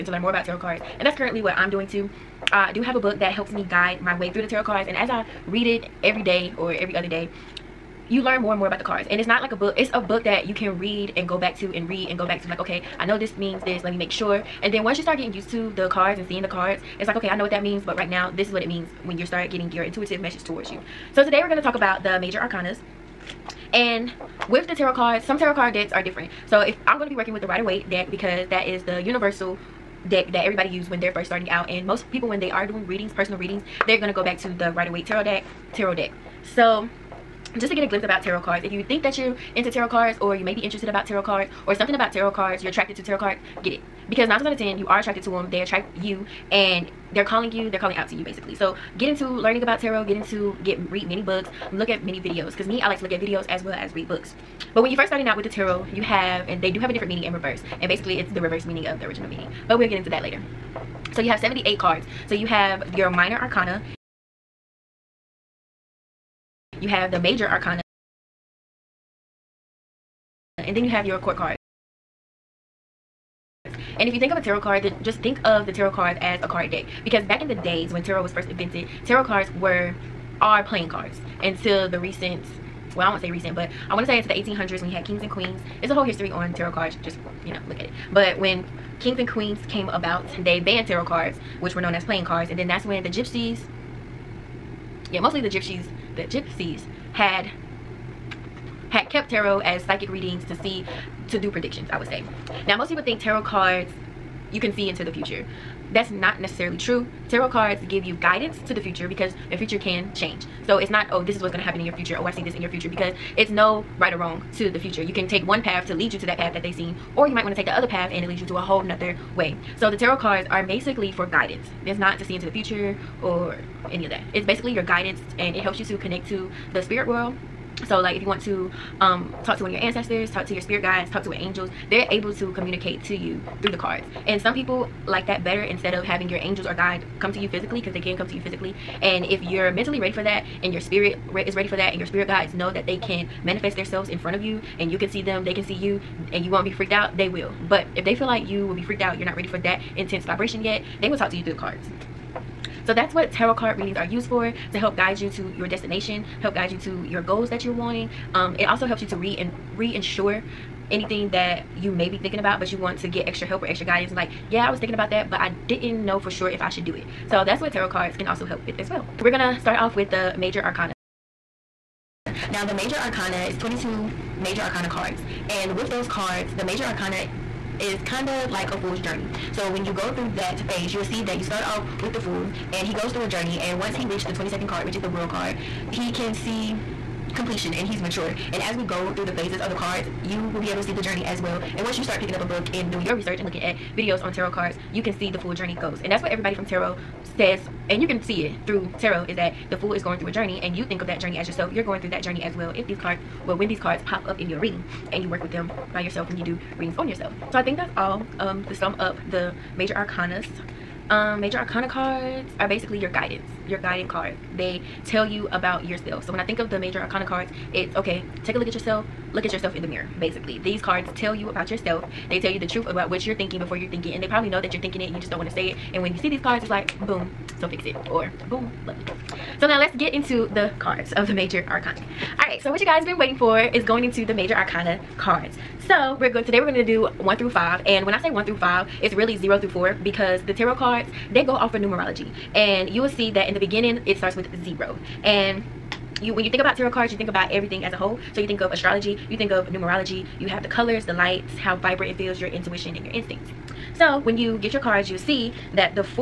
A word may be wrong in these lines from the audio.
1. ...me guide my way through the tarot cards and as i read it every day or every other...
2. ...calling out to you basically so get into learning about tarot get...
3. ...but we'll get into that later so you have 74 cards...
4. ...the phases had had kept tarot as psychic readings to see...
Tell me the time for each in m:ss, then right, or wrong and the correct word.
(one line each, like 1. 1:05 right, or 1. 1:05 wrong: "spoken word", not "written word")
1. 0:03 right
2. 0:47 right
3. 0:59 wrong: "78", not "74"
4. 1:36 wrong: "gypsies", not "phases".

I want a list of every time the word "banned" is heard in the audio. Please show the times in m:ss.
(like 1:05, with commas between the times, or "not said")
1:30.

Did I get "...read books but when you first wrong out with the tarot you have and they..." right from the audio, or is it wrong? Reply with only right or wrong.
wrong.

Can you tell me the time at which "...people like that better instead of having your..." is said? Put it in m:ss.
2:14.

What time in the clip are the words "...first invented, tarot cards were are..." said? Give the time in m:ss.
1:18.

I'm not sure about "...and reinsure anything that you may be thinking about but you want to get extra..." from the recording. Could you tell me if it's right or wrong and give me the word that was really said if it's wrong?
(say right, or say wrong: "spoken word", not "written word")
right.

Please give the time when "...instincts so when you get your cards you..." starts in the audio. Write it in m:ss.
4:13.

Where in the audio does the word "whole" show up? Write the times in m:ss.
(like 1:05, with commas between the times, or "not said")
1:25, 1:58, 4:07.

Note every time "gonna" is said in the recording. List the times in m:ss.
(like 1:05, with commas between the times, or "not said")
0:34, 2:49.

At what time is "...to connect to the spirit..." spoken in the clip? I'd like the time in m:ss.
2:05.